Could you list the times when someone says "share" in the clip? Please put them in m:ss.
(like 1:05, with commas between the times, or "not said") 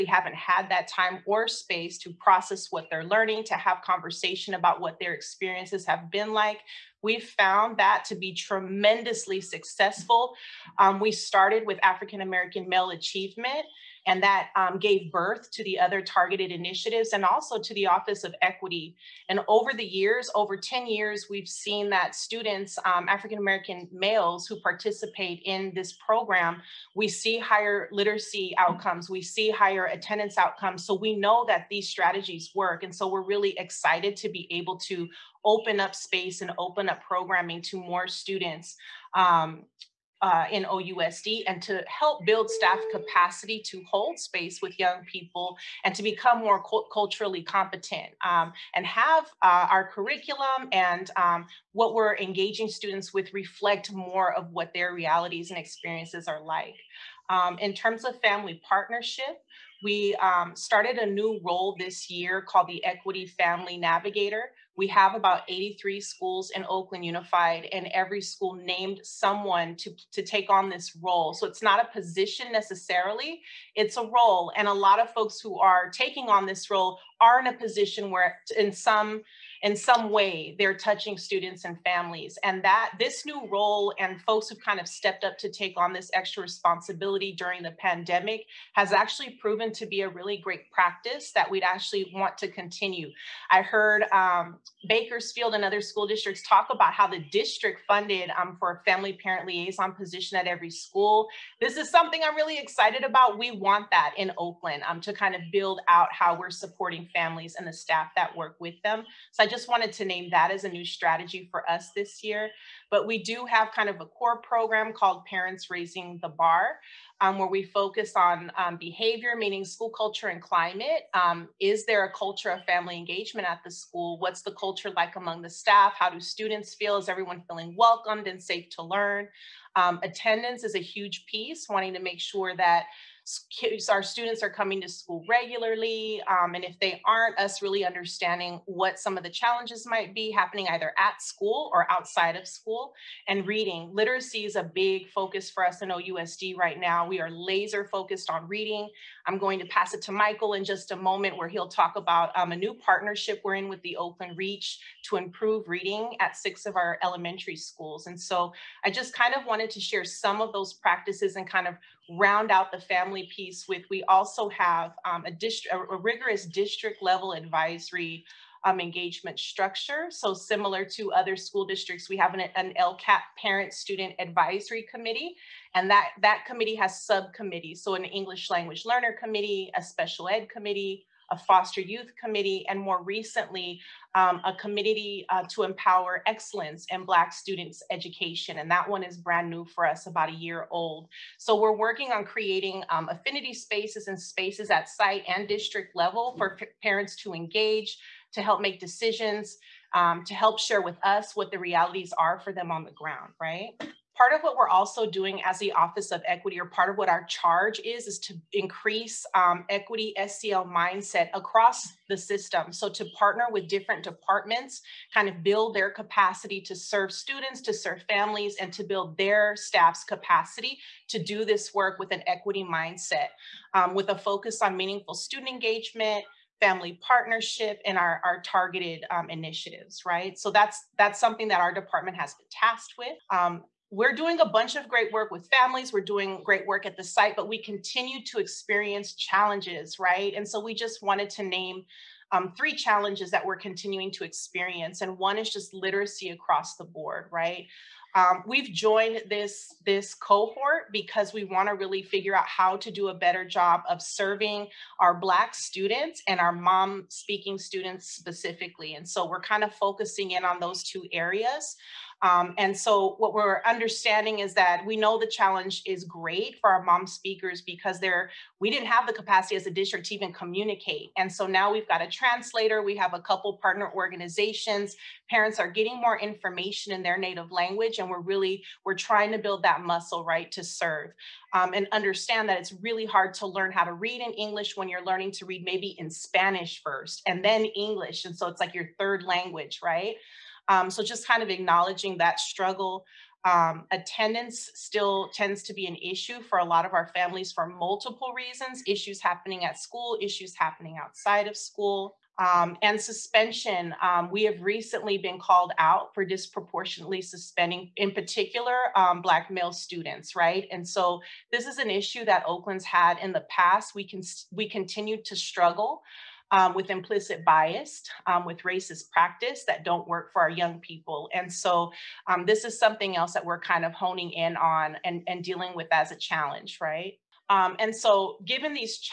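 2:39, 3:20.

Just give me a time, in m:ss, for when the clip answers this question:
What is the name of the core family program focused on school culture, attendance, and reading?
1:55.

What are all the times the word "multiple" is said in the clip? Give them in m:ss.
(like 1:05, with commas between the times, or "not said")
4:57.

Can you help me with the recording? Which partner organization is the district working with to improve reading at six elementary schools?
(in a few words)
Oakland Reach.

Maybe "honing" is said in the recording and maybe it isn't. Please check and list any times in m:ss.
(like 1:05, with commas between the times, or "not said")
5:23.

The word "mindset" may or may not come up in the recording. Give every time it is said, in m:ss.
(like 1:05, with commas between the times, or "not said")
3:30, 3:42.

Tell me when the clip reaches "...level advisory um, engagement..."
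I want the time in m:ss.
2:47.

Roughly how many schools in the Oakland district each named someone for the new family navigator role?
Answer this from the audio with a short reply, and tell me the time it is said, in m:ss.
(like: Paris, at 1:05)
83, at 1:05.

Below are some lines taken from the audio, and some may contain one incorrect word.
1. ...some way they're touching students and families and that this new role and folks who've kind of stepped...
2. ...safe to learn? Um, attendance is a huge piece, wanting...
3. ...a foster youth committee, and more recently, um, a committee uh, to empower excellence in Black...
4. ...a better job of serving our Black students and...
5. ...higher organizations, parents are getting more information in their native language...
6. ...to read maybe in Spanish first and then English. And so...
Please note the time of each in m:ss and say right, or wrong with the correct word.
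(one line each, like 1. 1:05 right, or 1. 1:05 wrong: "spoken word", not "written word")
1. 1:19 right
2. 2:08 right
3. 3:01 right
4. 4:13 right
5. 4:33 wrong: "partner", not "higher"
6. 4:45 right.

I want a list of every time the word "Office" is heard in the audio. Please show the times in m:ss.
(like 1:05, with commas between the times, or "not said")
0:17, 3:25.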